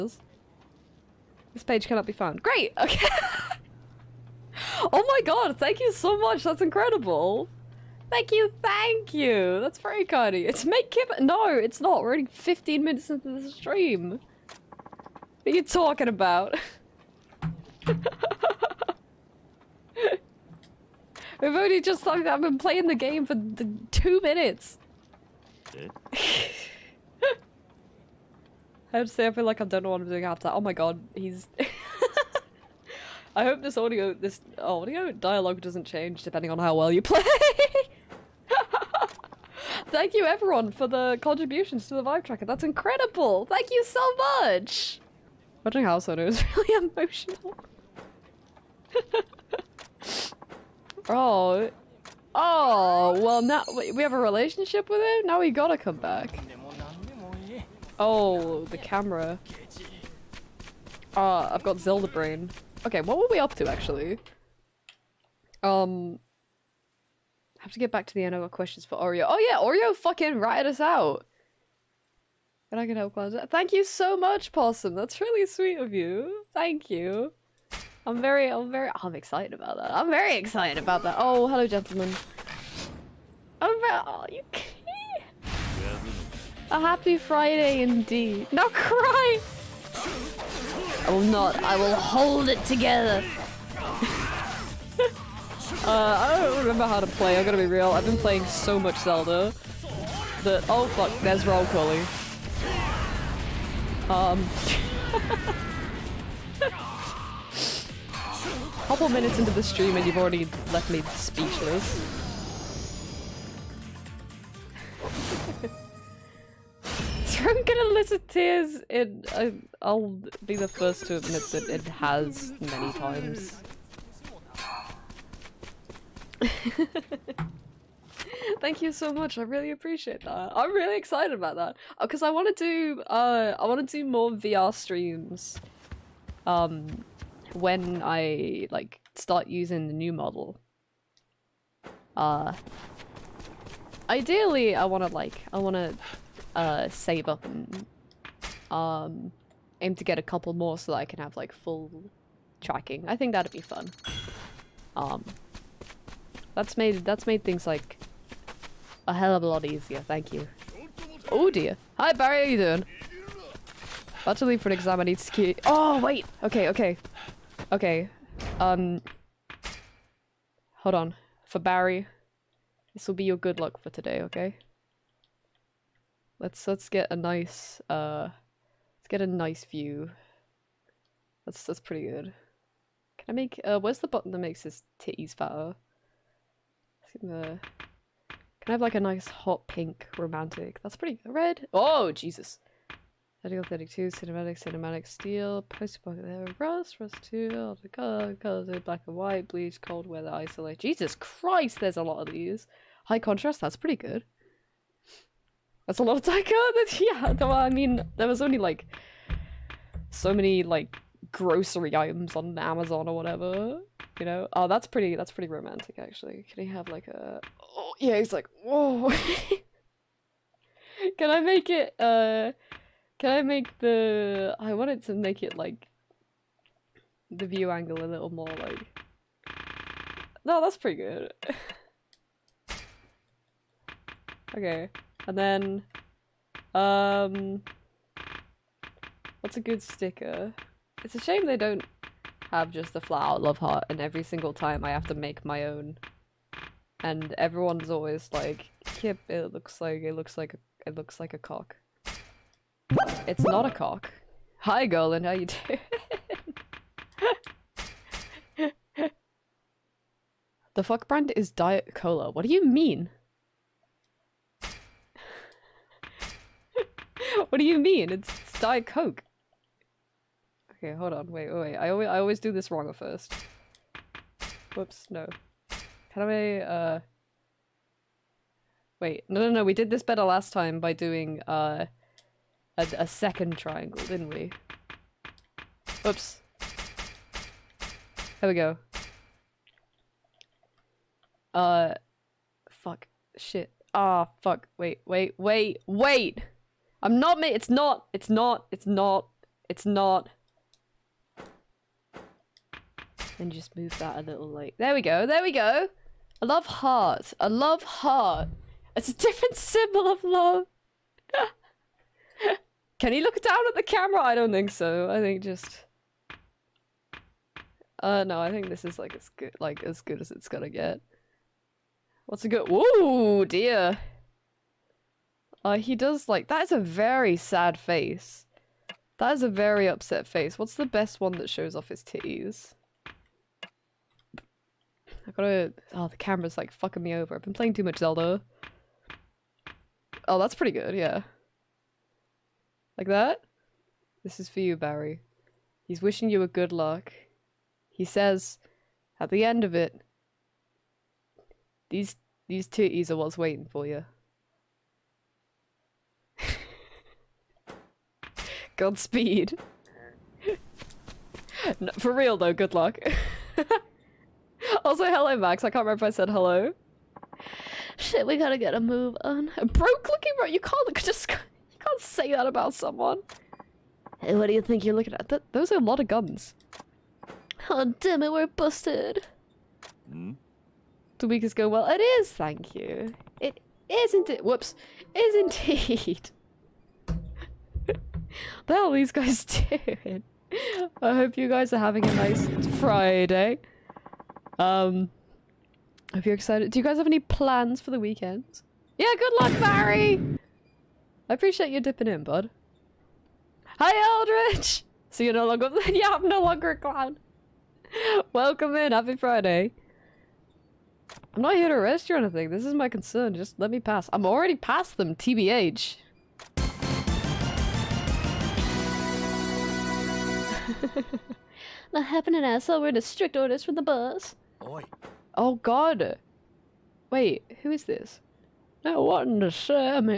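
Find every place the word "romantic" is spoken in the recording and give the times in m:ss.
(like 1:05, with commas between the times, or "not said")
3:10, 3:35.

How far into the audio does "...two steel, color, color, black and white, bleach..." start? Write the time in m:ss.
3:17.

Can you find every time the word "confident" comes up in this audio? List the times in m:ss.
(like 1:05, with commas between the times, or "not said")
not said.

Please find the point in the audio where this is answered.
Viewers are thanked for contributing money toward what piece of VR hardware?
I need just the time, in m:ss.
0:42.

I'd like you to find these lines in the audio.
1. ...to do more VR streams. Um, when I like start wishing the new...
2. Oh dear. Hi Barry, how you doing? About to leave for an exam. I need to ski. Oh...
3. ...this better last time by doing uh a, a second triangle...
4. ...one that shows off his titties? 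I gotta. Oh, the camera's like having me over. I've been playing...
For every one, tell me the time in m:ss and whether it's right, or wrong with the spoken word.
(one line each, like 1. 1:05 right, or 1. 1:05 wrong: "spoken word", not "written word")
1. 2:13 wrong: "using", not "wishing"
2. 2:41 right
3. 4:39 right
4. 5:31 wrong: "fucking", not "having".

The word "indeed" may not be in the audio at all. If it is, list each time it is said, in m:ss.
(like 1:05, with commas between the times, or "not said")
1:27, 6:25.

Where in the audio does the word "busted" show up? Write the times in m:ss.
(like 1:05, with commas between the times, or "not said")
6:18.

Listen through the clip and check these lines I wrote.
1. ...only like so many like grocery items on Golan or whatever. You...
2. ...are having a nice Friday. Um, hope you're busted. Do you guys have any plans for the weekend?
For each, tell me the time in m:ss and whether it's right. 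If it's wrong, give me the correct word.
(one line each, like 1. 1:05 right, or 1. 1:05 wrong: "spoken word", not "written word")
1. 3:28 wrong: "Amazon", not "Golan"
2. 6:31 wrong: "excited", not "busted".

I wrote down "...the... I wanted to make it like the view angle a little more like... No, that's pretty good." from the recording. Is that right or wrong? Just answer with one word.
right.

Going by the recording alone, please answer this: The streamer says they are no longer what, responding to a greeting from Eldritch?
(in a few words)
a clown.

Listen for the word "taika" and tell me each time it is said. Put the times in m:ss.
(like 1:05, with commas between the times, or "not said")
3:26.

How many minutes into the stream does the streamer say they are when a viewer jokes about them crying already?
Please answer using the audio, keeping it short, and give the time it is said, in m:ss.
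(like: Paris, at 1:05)
15, at 0:12.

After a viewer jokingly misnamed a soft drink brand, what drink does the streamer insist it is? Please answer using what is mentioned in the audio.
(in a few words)
Diet Coke.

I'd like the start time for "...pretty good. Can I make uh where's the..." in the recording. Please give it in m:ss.
3:01.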